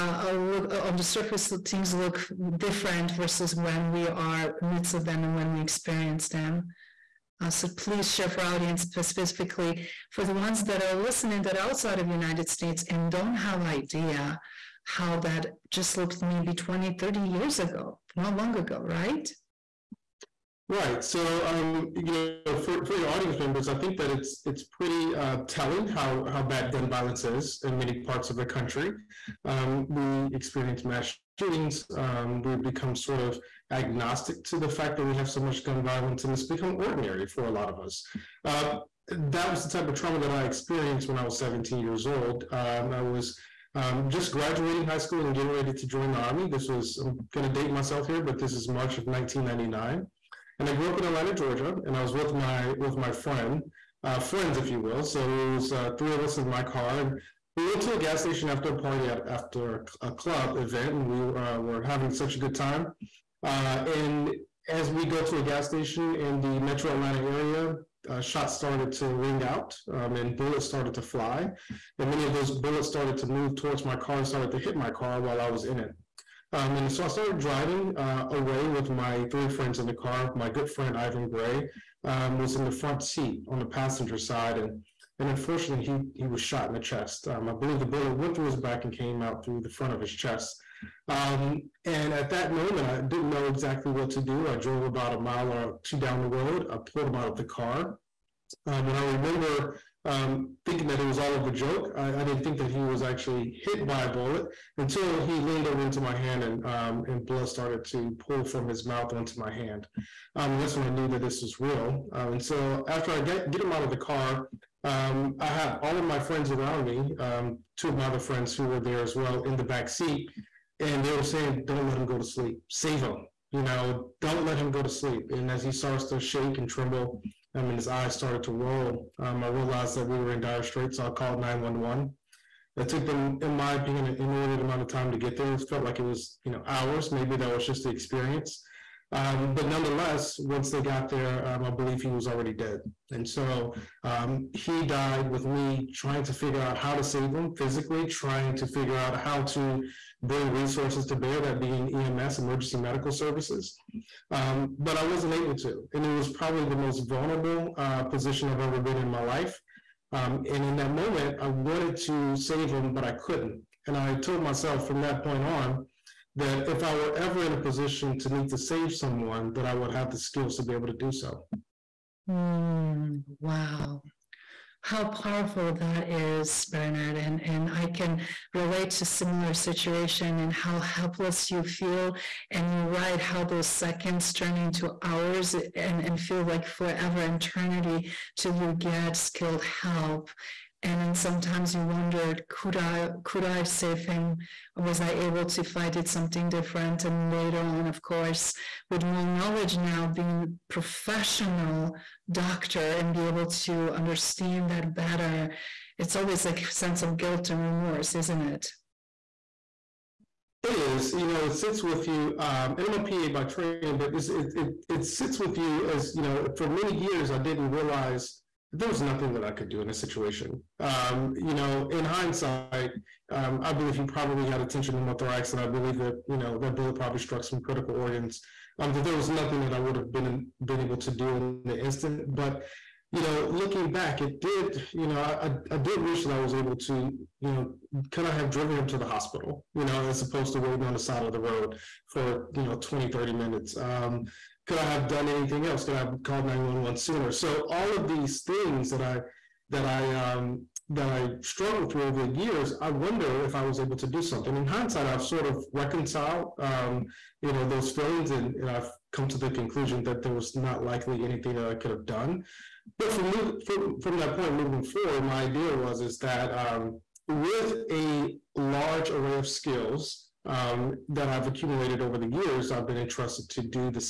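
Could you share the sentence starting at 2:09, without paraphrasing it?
Um, I realized that we were in dire straits, so I called nine one one.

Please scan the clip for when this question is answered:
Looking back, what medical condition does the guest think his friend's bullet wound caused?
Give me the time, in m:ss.
3:44.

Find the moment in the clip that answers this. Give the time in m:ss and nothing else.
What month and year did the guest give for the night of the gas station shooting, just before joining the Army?
0:48.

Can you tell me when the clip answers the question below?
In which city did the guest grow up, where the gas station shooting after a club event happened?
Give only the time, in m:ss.
0:51.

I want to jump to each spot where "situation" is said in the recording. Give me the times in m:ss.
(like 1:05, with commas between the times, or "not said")
2:59, 3:39.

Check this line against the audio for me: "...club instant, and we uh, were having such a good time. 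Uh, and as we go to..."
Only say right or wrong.
wrong.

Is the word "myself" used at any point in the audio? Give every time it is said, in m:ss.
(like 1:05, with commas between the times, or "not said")
0:47, 2:44.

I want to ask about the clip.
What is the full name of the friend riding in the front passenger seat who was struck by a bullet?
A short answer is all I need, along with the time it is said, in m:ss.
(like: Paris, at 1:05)
Ivan Gray, at 1:20.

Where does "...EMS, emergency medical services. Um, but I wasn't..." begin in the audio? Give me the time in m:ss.
2:31.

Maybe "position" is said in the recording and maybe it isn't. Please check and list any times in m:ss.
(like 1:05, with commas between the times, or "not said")
2:38, 2:47.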